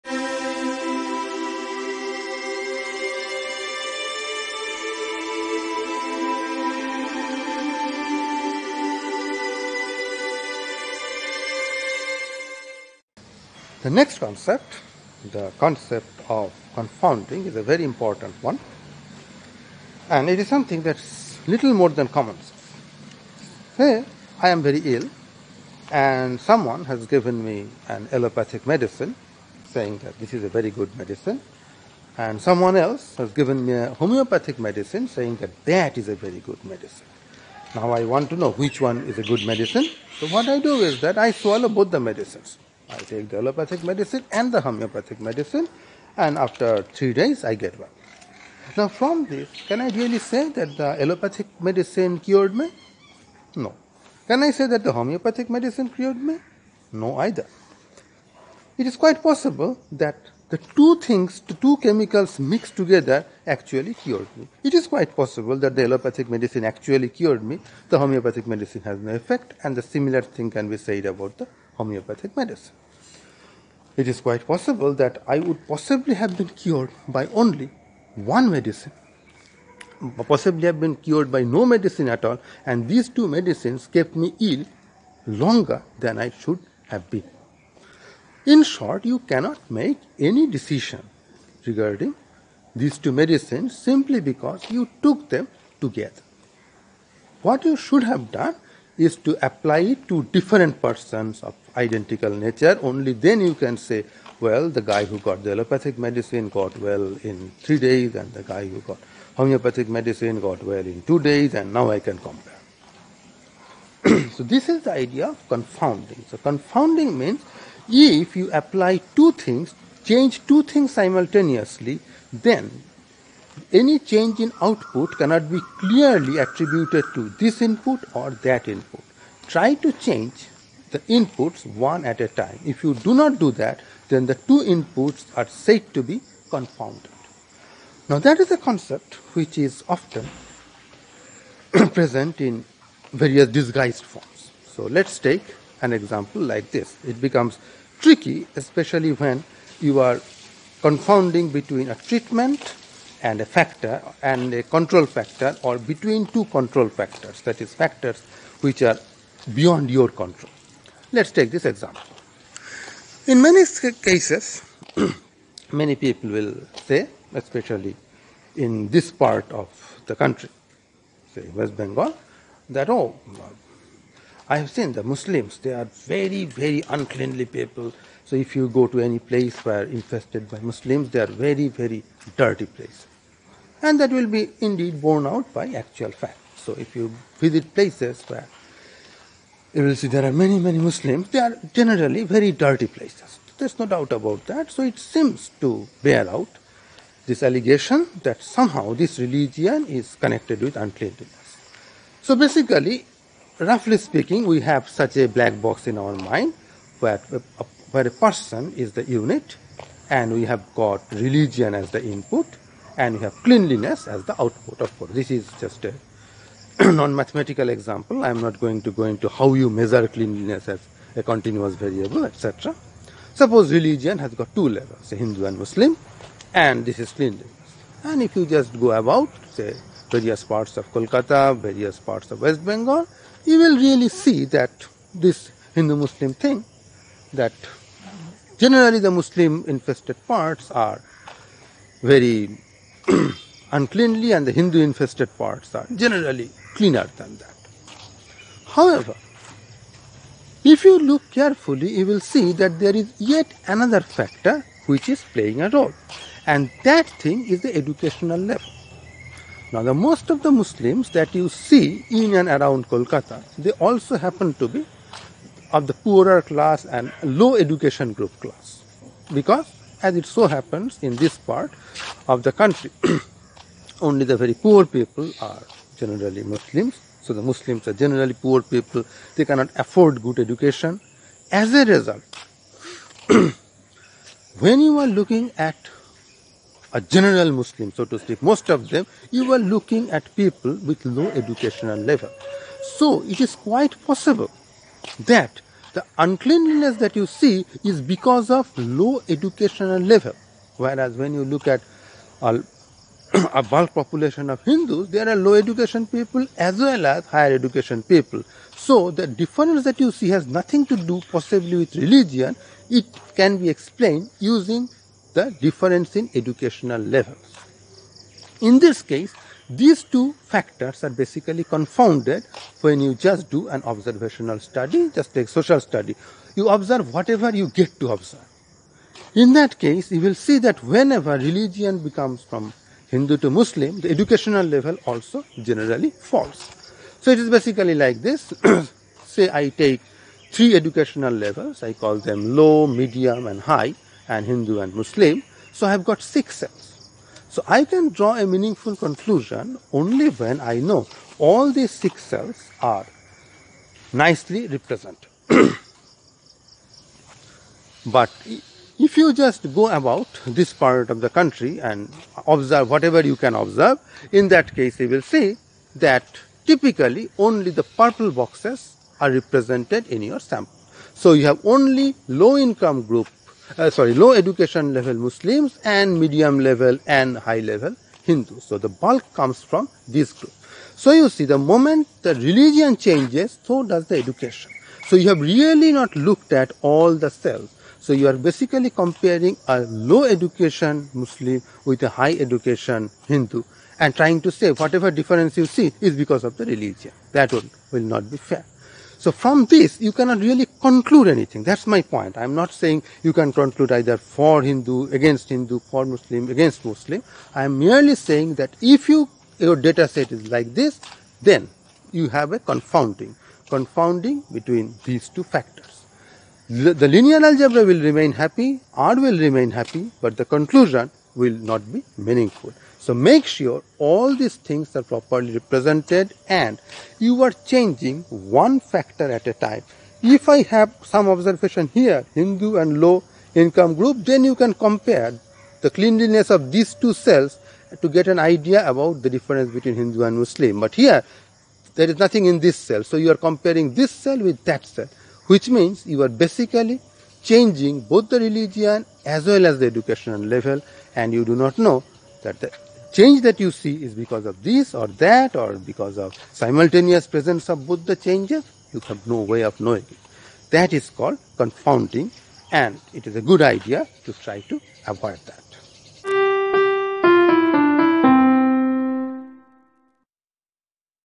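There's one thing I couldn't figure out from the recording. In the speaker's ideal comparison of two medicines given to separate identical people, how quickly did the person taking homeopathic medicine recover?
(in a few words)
2 days.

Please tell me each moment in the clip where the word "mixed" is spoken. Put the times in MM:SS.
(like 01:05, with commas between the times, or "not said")
01:02.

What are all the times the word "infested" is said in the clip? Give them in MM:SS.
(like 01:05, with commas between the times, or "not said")
02:59, 03:59, 04:04.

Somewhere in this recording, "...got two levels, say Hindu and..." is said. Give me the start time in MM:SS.
03:44.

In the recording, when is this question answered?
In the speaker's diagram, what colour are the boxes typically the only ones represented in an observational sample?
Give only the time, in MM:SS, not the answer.
06:07.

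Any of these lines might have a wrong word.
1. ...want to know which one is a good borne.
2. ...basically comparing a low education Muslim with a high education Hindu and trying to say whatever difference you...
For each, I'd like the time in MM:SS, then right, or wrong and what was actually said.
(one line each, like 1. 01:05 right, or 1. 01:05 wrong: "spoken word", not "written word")
1. 00:38 wrong: "medicine", not "borne"
2. 06:28 right.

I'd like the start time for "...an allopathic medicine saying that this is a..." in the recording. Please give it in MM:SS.
00:27.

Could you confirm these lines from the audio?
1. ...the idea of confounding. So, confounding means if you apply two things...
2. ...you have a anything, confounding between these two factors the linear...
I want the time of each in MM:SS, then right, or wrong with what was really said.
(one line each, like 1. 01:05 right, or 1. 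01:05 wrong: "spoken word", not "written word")
1. 01:54 right
2. 06:52 wrong: "confounding", not "anything".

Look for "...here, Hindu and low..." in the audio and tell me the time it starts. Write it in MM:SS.
07:11.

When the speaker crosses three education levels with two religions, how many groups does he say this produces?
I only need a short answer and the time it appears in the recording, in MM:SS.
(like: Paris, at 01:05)
6, at 05:46.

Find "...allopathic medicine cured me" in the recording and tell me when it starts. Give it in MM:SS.
00:51.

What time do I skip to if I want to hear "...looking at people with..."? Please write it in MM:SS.
04:49.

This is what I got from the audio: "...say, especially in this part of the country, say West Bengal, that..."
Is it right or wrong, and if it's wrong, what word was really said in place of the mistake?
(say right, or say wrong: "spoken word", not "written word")
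right.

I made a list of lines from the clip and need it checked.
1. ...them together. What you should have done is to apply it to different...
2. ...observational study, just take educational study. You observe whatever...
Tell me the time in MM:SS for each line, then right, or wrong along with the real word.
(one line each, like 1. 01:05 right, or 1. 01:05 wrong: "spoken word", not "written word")
1. 01:35 right
2. 05:23 wrong: "social", not "educational".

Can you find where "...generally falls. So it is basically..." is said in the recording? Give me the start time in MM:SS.
05:35.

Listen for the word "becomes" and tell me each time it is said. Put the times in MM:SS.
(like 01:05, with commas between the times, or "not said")
02:27, 05:31.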